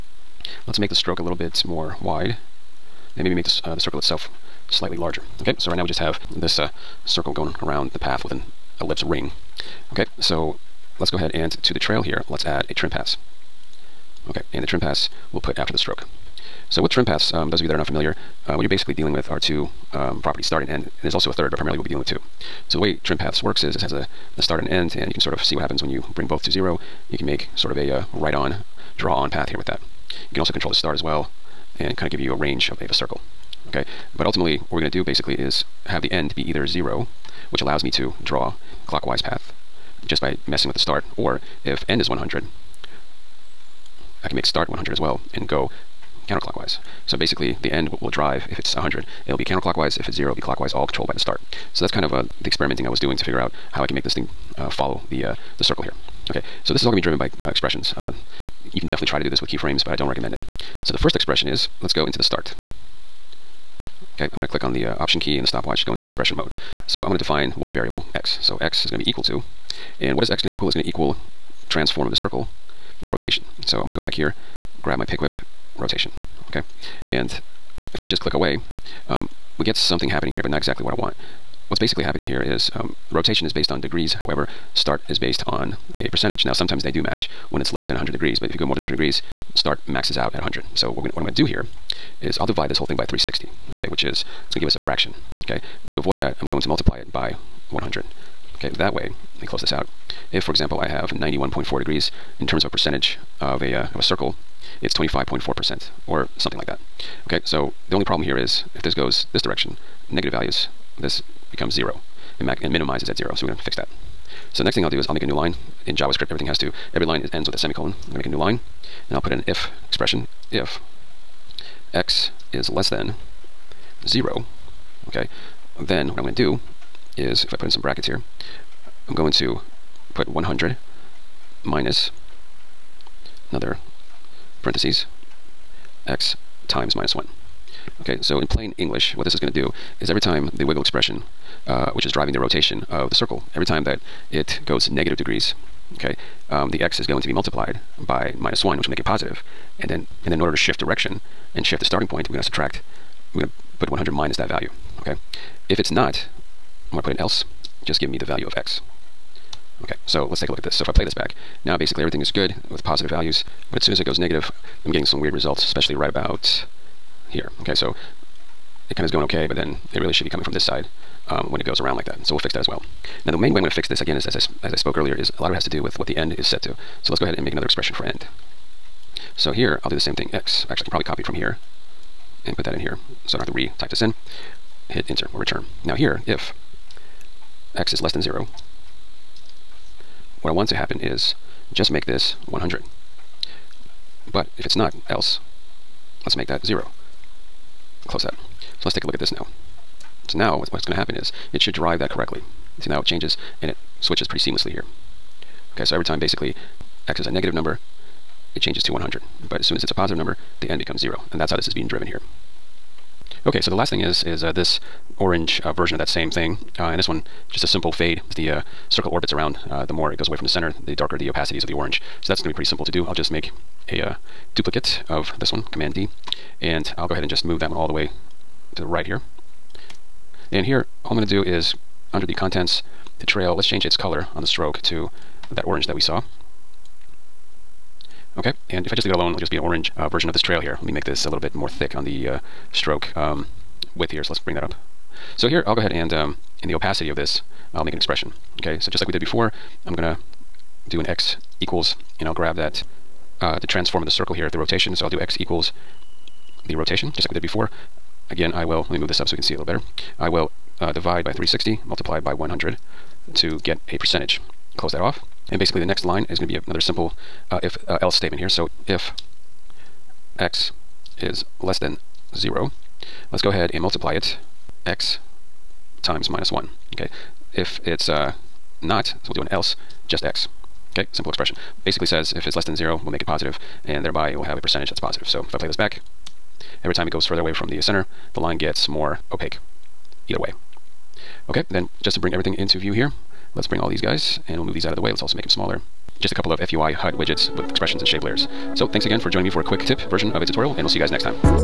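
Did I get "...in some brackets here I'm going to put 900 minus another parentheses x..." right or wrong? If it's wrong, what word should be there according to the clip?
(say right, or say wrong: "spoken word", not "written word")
wrong: "100", not "900".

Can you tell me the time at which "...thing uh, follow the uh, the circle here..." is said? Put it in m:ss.
0:54.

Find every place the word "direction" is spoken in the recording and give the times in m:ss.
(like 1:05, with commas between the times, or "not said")
1:49, 2:30.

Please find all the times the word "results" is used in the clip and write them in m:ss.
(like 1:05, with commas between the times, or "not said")
2:45.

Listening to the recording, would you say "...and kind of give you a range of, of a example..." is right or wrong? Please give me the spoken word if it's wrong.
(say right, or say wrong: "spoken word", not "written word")
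wrong: "circle", not "example".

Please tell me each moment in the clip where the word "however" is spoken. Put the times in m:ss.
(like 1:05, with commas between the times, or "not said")
1:24.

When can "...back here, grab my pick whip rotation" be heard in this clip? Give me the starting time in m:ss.
1:14.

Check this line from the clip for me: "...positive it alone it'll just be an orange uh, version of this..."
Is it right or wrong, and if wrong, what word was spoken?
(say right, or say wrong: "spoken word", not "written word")
wrong: "leave", not "positive".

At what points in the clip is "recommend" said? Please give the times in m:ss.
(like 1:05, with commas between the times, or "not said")
1:00.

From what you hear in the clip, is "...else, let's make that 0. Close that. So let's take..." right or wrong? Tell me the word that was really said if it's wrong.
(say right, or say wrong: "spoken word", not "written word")
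right.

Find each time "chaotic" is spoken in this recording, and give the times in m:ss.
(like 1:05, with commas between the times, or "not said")
not said.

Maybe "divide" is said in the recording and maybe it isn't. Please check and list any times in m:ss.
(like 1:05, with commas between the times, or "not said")
1:32, 4:20.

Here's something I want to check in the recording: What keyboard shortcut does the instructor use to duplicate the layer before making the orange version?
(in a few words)
command D.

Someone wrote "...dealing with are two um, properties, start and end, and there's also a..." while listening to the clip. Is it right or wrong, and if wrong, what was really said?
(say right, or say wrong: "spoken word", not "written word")
right.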